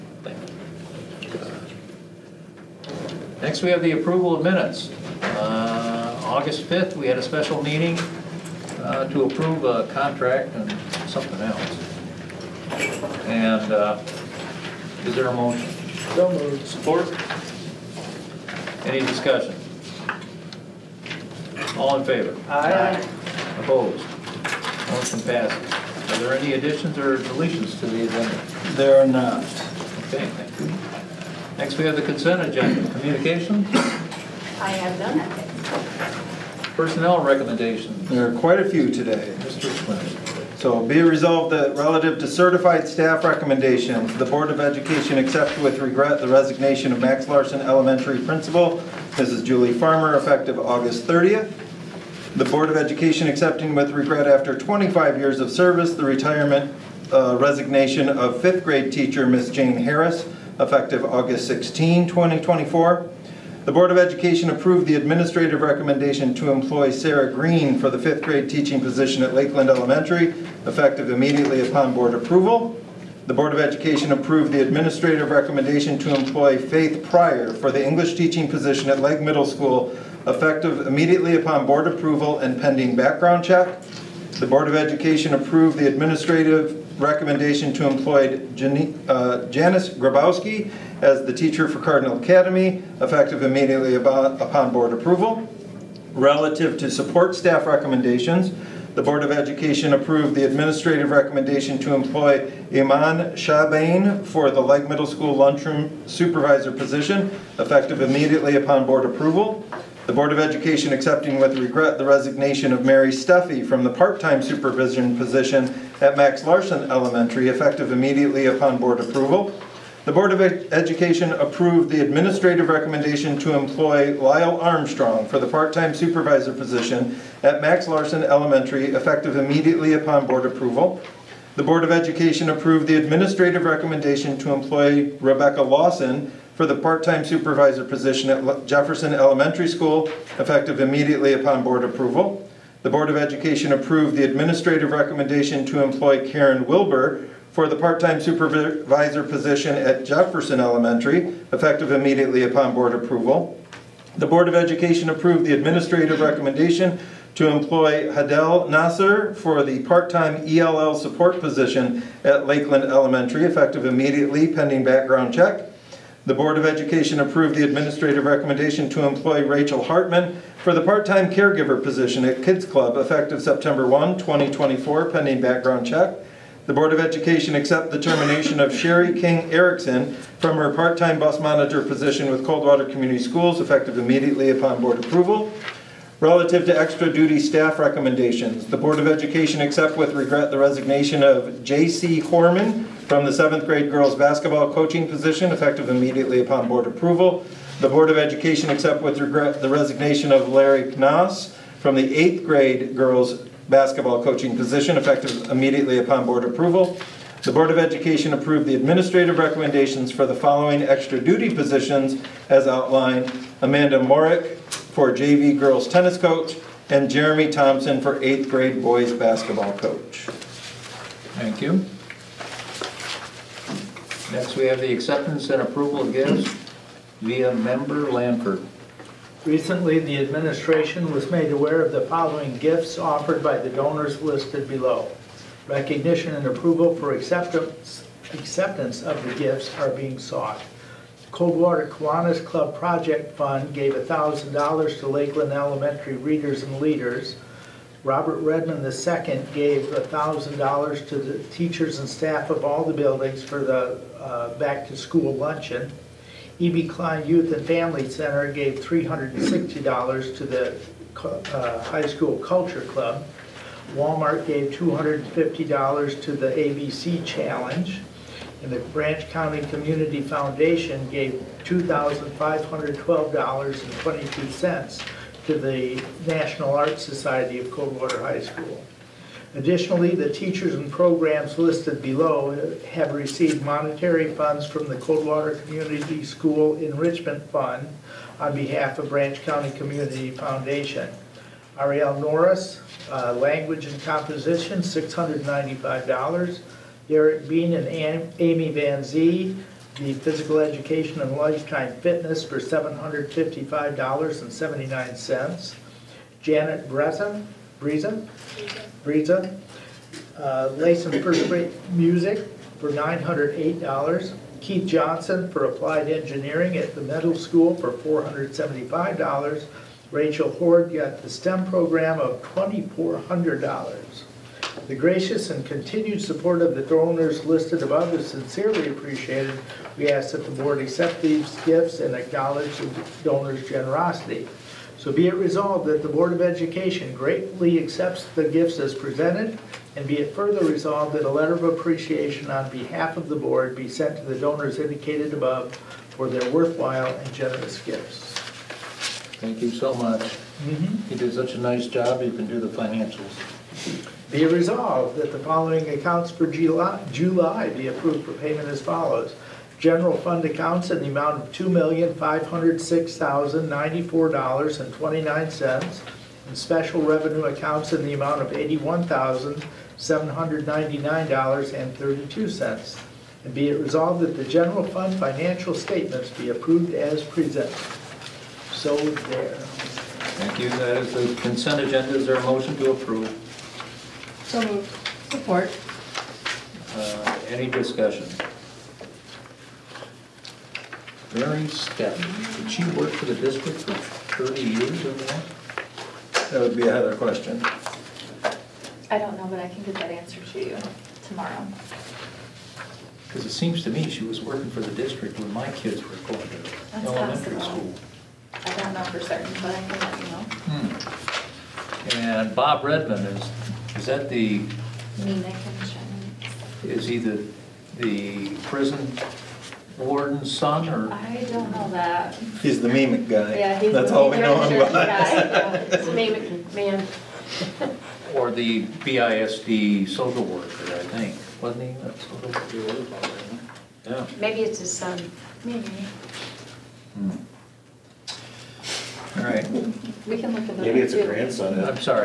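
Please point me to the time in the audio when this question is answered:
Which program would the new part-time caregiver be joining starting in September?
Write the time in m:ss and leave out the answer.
2:52.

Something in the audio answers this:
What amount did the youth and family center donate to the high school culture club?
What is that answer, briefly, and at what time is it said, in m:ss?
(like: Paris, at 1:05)
$360, at 4:18.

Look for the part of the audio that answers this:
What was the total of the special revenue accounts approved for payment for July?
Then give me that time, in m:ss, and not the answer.
6:08.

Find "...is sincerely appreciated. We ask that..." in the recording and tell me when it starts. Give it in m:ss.
5:28.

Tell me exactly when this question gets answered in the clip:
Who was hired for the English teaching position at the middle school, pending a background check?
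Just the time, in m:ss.
1:16.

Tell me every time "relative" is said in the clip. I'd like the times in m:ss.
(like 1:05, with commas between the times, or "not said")
0:41, 1:36, 3:06.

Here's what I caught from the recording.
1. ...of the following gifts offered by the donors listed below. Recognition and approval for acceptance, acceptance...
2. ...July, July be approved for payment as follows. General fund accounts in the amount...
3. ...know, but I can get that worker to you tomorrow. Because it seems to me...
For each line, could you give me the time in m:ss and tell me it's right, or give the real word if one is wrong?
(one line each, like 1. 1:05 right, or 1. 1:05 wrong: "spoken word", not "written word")
1. 3:51 right
2. 5:56 right
3. 6:39 wrong: "answer", not "worker".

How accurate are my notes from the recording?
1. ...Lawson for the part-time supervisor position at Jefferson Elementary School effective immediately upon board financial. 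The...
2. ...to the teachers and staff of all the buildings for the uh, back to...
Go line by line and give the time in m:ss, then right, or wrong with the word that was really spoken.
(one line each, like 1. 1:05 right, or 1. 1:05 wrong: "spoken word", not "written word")
1. 2:15 wrong: "approval", not "financial"
2. 4:11 right.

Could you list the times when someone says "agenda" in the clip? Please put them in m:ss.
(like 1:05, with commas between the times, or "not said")
0:28, 0:32, 6:21.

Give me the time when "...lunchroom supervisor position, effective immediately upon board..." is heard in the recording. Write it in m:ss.
1:45.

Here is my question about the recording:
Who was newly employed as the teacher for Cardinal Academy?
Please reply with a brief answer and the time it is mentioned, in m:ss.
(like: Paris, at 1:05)
Janice Grabowski, at 1:29.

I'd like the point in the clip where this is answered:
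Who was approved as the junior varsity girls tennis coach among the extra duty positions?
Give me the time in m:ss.
3:33.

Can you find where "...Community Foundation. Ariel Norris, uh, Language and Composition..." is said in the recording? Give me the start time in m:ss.
4:49.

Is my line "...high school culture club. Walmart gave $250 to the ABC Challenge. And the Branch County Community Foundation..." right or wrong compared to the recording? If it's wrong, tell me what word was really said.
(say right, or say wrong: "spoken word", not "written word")
right.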